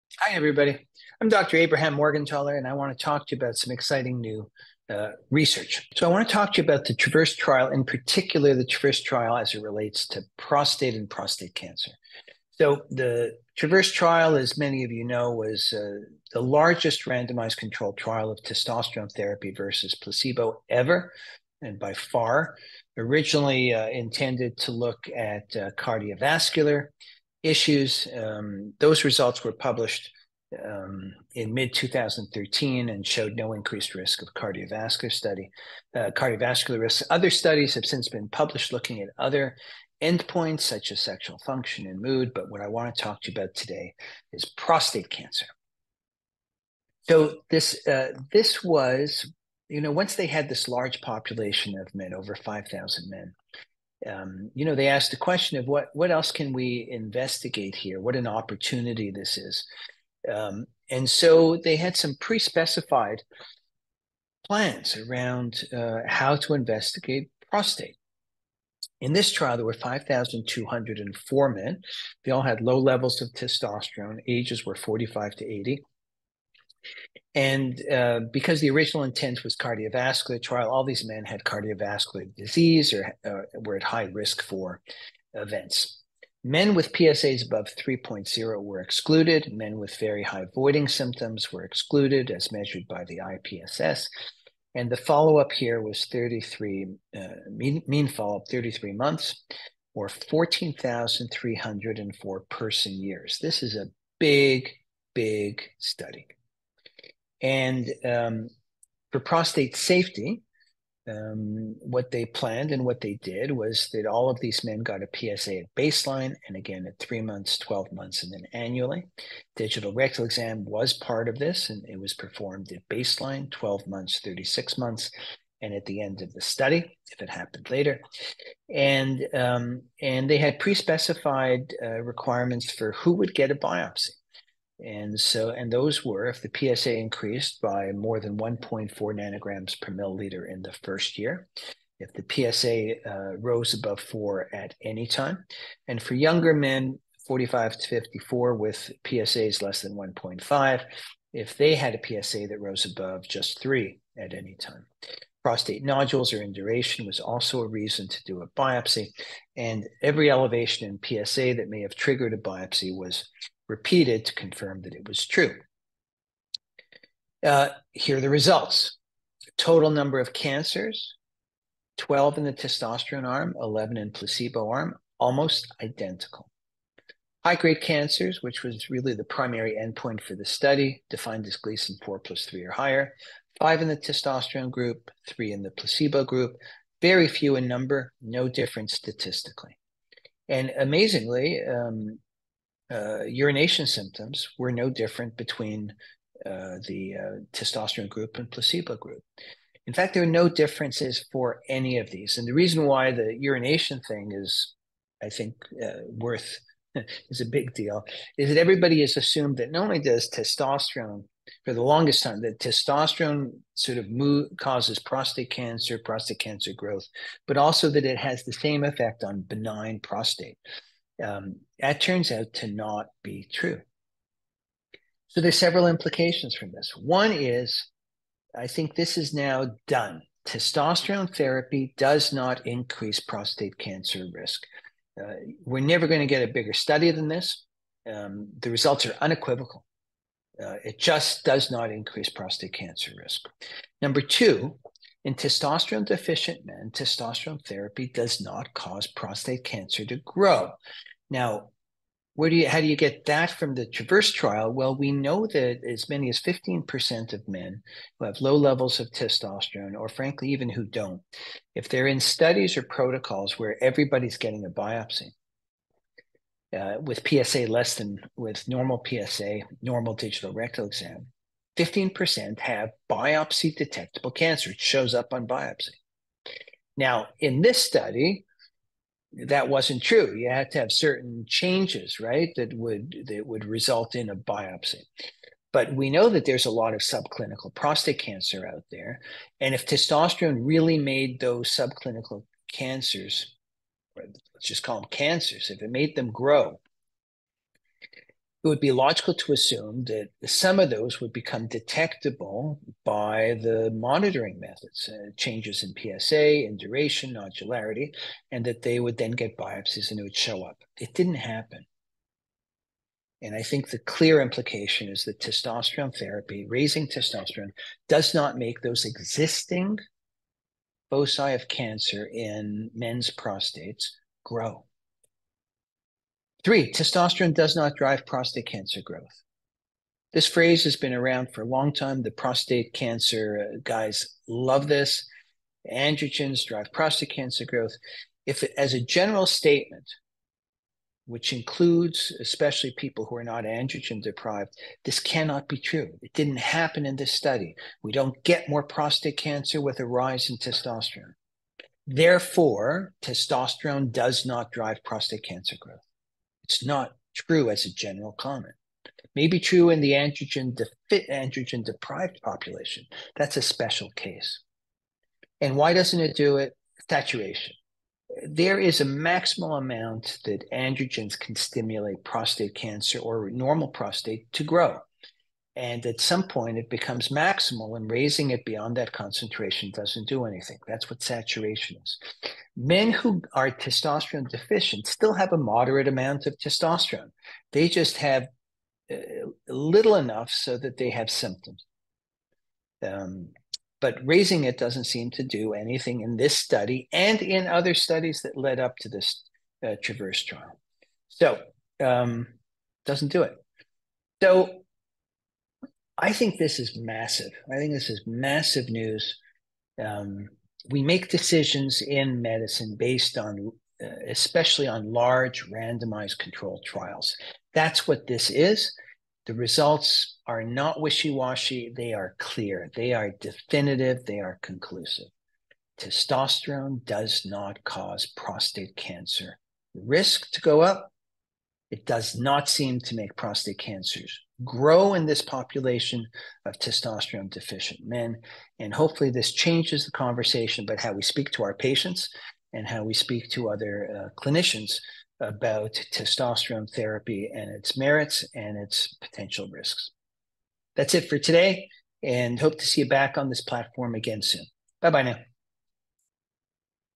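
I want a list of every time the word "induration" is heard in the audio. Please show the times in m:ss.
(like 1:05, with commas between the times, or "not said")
2:36, 5:06.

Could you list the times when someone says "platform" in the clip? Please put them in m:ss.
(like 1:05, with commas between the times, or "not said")
7:33.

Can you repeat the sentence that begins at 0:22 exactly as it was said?
Originally uh, intended to look at uh, cardiovascular issues.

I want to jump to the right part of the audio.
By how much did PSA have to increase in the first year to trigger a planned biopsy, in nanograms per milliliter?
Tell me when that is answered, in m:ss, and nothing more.
2:18.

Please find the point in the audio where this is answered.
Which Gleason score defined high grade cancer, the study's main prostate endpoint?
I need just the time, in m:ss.
3:02.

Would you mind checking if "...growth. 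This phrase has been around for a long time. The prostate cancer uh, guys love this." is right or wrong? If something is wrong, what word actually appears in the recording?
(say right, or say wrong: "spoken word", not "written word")
right.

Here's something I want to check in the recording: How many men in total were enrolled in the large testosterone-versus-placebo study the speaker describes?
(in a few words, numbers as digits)
5,204.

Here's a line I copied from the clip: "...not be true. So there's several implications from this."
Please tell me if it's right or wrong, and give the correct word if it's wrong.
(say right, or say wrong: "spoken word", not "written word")
right.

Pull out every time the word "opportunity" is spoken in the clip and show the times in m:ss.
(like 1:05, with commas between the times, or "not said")
0:58.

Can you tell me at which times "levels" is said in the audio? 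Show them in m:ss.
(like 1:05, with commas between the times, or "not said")
1:12, 4:18.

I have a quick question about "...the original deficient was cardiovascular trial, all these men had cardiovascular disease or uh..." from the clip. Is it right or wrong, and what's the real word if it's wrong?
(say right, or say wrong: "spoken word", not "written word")
wrong: "intent", not "deficient".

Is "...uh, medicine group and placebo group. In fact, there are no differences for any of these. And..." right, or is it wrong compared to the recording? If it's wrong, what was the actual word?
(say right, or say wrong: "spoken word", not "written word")
wrong: "testosterone", not "medicine".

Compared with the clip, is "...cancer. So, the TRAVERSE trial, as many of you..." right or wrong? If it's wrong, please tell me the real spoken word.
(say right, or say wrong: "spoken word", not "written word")
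right.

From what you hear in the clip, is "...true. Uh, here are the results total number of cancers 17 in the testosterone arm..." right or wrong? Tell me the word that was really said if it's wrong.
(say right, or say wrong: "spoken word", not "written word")
wrong: "12", not "17".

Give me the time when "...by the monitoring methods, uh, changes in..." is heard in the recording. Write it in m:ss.
5:03.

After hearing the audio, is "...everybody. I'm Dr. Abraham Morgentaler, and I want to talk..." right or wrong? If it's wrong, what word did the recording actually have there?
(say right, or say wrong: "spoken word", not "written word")
right.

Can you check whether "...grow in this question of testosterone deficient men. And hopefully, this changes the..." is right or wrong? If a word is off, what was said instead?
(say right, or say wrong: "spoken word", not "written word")
wrong: "population", not "question".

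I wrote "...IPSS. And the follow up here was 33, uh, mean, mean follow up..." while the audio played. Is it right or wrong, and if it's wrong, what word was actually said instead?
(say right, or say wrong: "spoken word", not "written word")
right.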